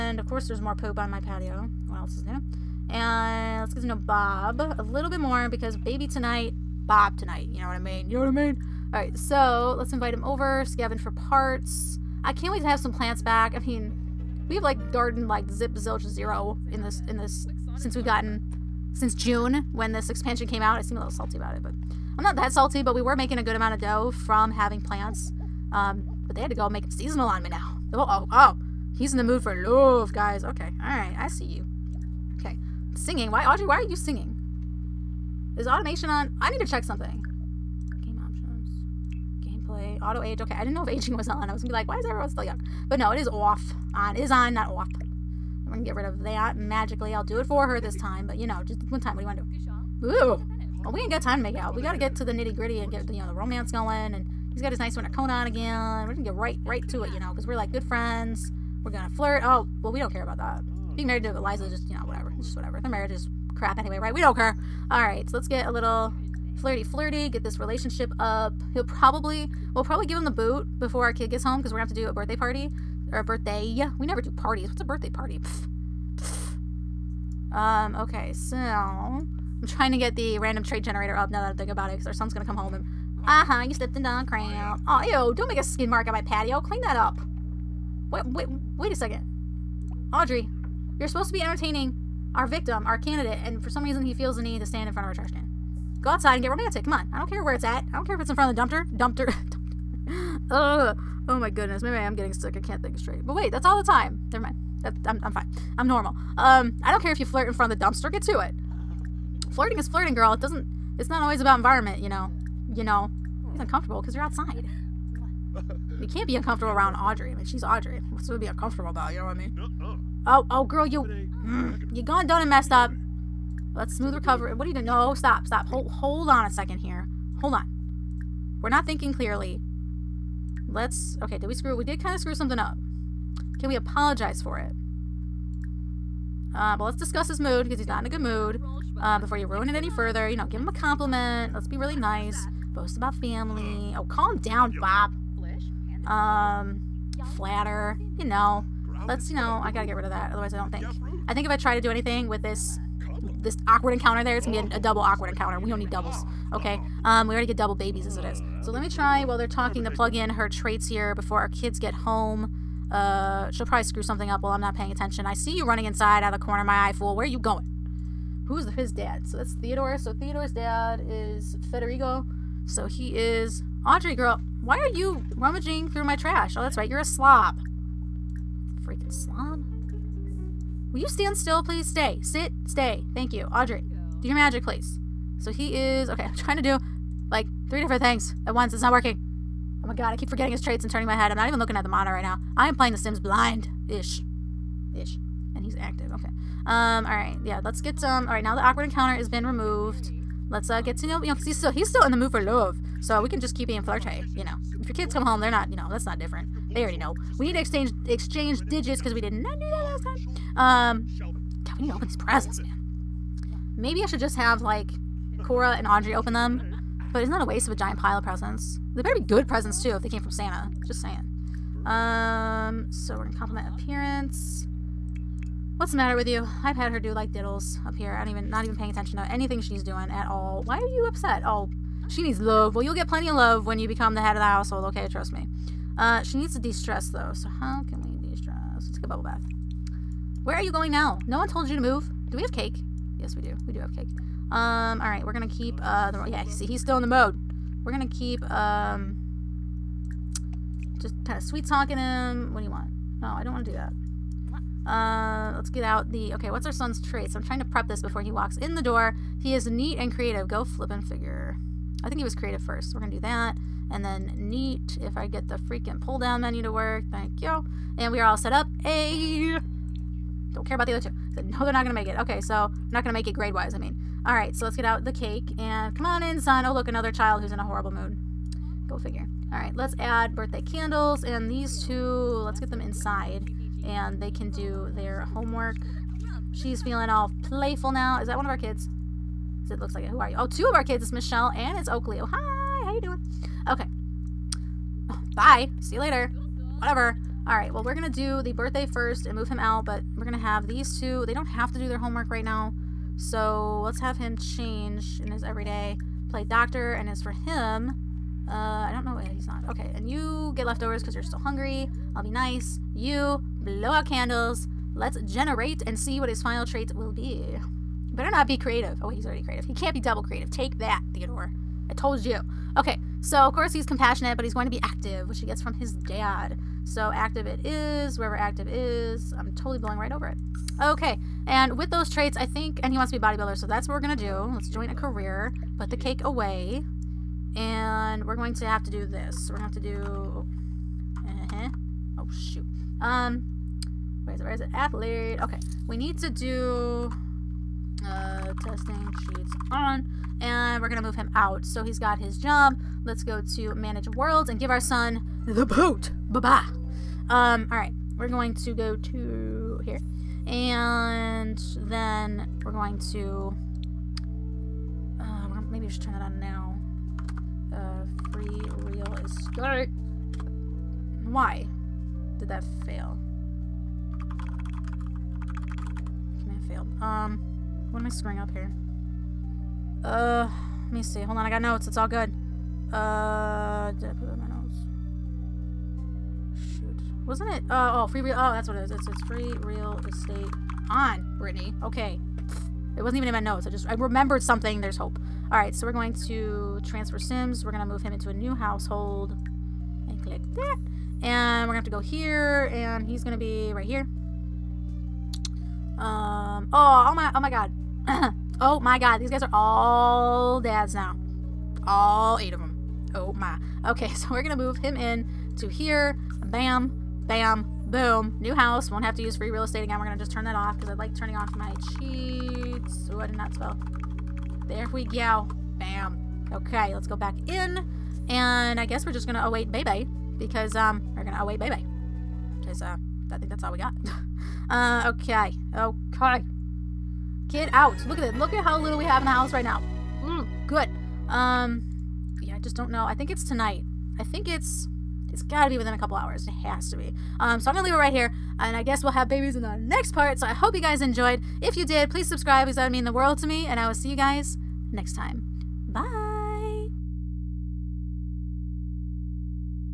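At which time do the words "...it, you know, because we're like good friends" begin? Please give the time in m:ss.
0:57.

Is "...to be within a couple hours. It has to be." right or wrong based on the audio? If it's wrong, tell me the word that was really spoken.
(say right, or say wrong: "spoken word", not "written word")
right.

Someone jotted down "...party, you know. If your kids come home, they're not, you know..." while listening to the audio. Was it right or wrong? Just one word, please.
wrong.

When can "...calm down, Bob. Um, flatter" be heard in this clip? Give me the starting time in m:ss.
2:24.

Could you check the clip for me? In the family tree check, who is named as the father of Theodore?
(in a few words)
Federico.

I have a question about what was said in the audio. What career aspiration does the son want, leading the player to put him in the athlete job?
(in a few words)
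bodybuilder.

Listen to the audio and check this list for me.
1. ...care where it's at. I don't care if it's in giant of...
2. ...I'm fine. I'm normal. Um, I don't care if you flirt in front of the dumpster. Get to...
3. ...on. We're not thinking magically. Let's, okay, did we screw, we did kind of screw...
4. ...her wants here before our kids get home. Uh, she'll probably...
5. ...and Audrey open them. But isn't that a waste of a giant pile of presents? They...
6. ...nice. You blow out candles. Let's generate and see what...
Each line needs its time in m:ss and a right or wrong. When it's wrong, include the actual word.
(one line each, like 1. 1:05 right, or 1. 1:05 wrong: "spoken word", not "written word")
1. 1:37 wrong: "front", not "giant"
2. 1:45 right
3. 2:07 wrong: "clearly", not "magically"
4. 2:40 wrong: "traits", not "wants"
5. 3:35 right
6. 5:12 right.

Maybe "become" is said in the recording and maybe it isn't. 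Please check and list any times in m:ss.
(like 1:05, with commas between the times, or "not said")
3:53.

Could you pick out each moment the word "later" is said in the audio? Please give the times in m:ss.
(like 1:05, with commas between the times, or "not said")
4:55.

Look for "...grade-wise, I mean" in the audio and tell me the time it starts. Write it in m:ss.
4:33.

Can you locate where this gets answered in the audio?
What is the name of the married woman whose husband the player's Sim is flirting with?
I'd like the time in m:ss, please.
1:01.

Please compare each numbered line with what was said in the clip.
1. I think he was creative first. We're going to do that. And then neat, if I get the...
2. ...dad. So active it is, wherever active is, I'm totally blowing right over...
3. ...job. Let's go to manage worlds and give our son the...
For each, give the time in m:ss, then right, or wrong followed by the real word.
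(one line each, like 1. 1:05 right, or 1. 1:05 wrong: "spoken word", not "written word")
1. 4:22 right
2. 5:25 right
3. 5:52 right.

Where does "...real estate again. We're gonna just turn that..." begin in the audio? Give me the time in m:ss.
6:59.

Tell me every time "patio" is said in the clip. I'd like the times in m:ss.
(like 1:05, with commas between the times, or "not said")
0:01, 1:26.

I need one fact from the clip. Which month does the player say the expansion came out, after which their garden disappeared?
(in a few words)
June.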